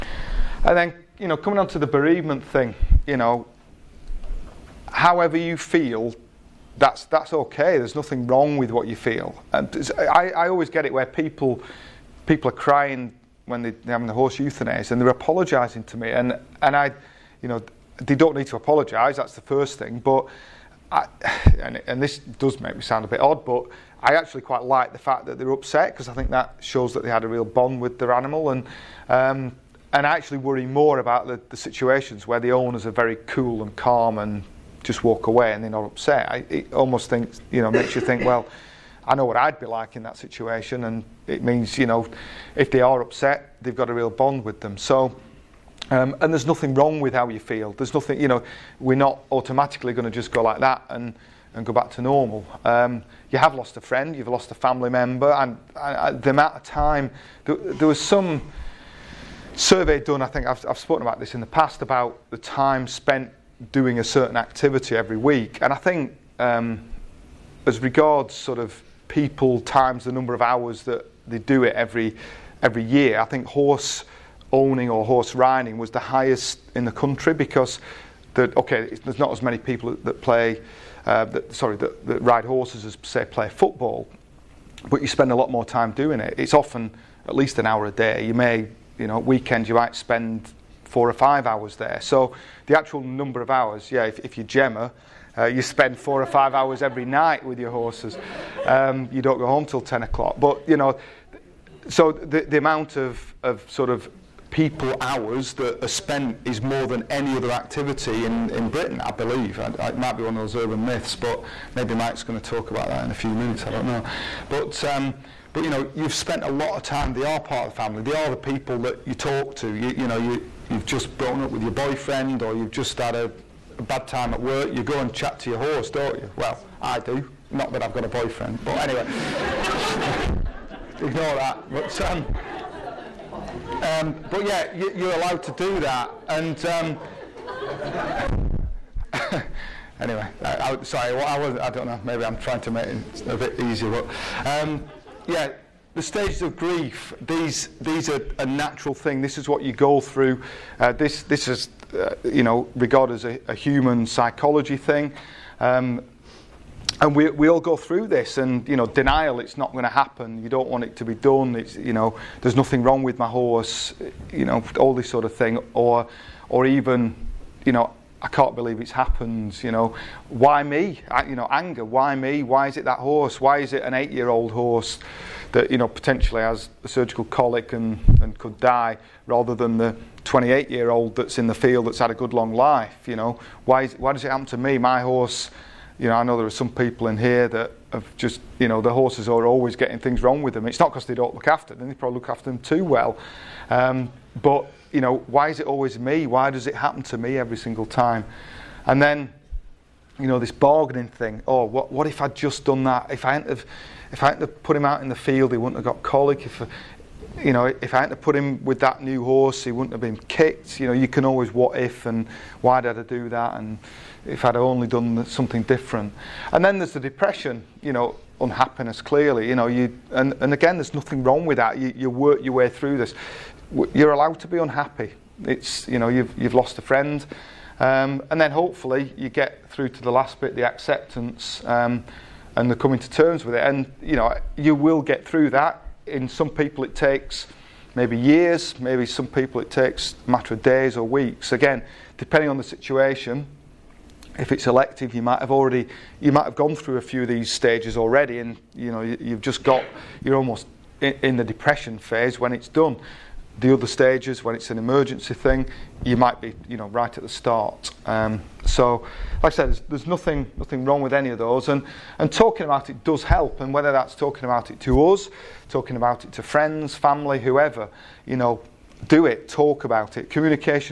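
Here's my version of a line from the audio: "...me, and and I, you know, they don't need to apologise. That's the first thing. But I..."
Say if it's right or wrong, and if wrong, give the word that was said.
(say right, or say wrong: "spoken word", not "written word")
right.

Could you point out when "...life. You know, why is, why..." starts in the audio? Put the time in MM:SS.
03:02.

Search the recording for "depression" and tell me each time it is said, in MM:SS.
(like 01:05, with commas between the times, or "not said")
03:36, 04:11.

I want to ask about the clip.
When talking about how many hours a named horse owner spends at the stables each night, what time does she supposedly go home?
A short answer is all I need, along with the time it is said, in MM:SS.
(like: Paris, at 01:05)
10 o'clock, at 01:39.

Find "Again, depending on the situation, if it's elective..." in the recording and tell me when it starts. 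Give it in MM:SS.
04:01.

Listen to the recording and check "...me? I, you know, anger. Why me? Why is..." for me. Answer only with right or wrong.
right.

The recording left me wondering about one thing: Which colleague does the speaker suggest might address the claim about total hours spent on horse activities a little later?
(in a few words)
Mike.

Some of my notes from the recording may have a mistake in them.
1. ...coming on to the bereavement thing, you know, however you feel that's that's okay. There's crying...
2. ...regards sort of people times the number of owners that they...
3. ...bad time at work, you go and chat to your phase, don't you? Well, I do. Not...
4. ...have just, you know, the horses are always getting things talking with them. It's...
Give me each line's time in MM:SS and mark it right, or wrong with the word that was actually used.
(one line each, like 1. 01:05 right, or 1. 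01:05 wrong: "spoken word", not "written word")
1. 00:01 wrong: "nothing", not "crying"
2. 01:07 wrong: "hours", not "owners"
3. 02:03 wrong: "horse", not "phase"
4. 03:07 wrong: "wrong", not "talking".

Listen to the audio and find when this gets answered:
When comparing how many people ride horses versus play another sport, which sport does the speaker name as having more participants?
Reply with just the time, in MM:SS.
01:23.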